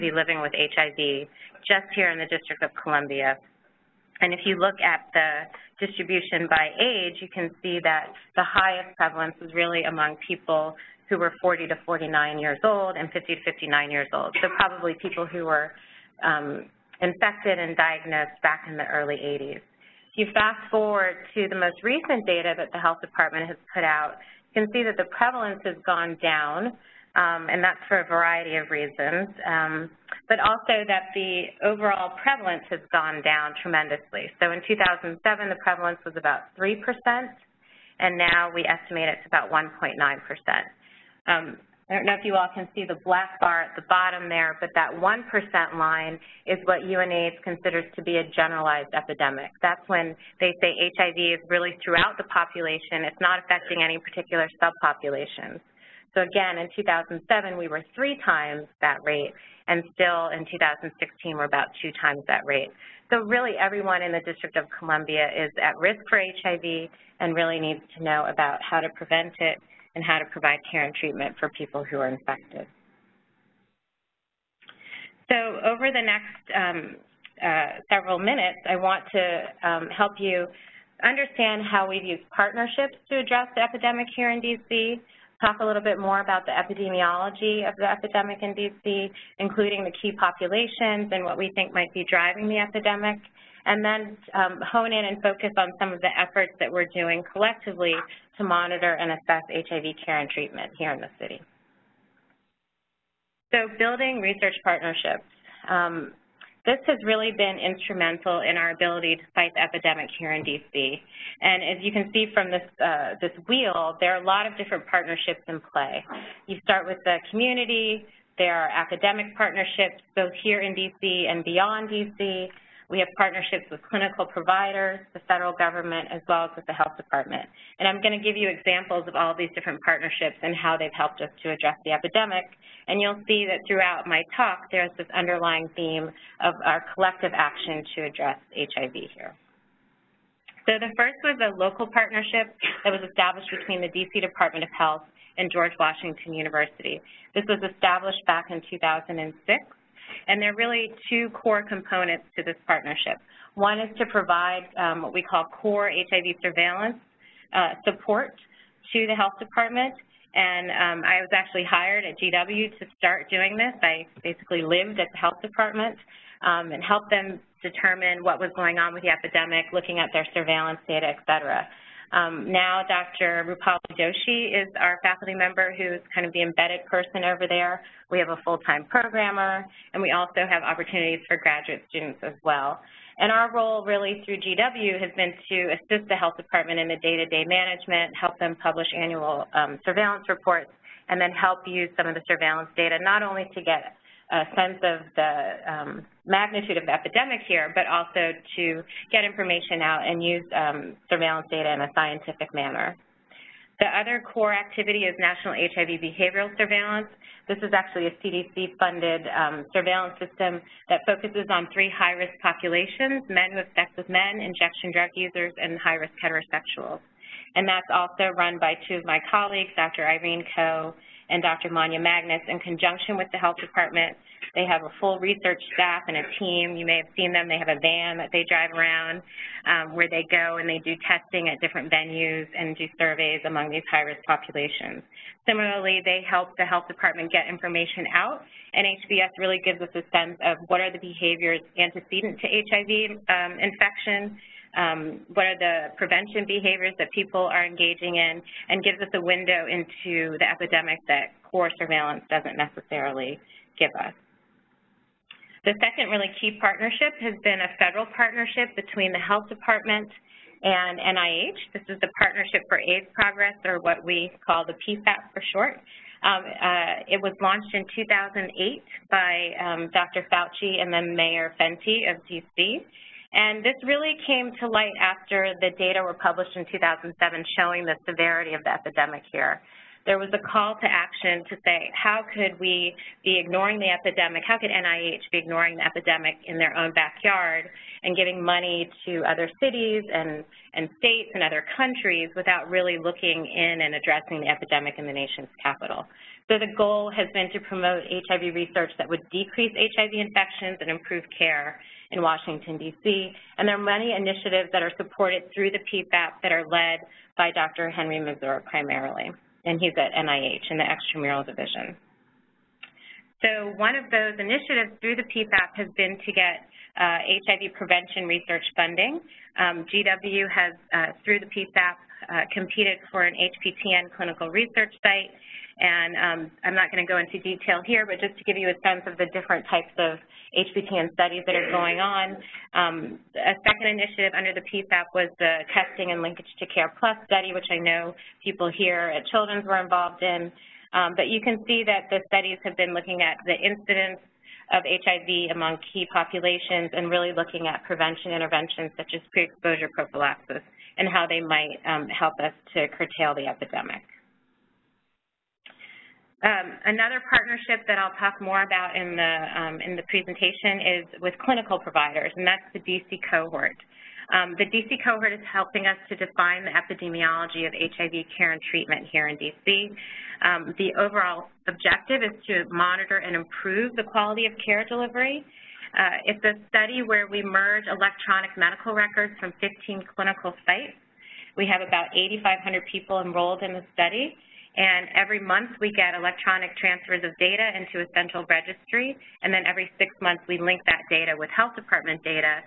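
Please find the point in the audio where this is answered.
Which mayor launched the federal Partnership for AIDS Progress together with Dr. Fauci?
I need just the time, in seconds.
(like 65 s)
271 s.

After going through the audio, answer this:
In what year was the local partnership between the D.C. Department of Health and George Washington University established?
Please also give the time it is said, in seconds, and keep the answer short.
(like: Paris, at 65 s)
2006, at 148 s.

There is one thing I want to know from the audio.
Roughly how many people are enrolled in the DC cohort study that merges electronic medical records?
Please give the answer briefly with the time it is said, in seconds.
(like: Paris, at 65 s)
8,500, at 382 s.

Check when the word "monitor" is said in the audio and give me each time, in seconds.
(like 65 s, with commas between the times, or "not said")
98 s, 372 s.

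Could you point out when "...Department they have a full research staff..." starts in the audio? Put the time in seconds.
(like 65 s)
223 s.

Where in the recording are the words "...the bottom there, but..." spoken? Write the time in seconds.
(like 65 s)
43 s.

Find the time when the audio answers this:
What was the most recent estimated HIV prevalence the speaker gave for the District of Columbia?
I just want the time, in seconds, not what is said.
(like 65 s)
39 s.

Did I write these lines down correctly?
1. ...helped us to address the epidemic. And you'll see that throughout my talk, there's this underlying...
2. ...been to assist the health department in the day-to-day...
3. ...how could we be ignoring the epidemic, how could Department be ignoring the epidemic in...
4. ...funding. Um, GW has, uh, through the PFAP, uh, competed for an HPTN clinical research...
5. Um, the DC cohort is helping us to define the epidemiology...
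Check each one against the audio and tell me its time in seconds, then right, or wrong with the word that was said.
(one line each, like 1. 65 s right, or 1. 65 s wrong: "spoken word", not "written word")
1. 130 s right
2. 185 s right
3. 281 s wrong: "NIH", not "Department"
4. 318 s right
5. 364 s right.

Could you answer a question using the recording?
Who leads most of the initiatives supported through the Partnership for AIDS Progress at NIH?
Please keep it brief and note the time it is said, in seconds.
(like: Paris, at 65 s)
Henry Masur, at 307 s.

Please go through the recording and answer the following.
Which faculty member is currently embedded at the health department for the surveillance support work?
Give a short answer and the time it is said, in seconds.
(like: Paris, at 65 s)
Rupali Doshi, at 173 s.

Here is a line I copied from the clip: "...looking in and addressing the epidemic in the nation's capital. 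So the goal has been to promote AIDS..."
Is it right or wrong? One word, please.
wrong.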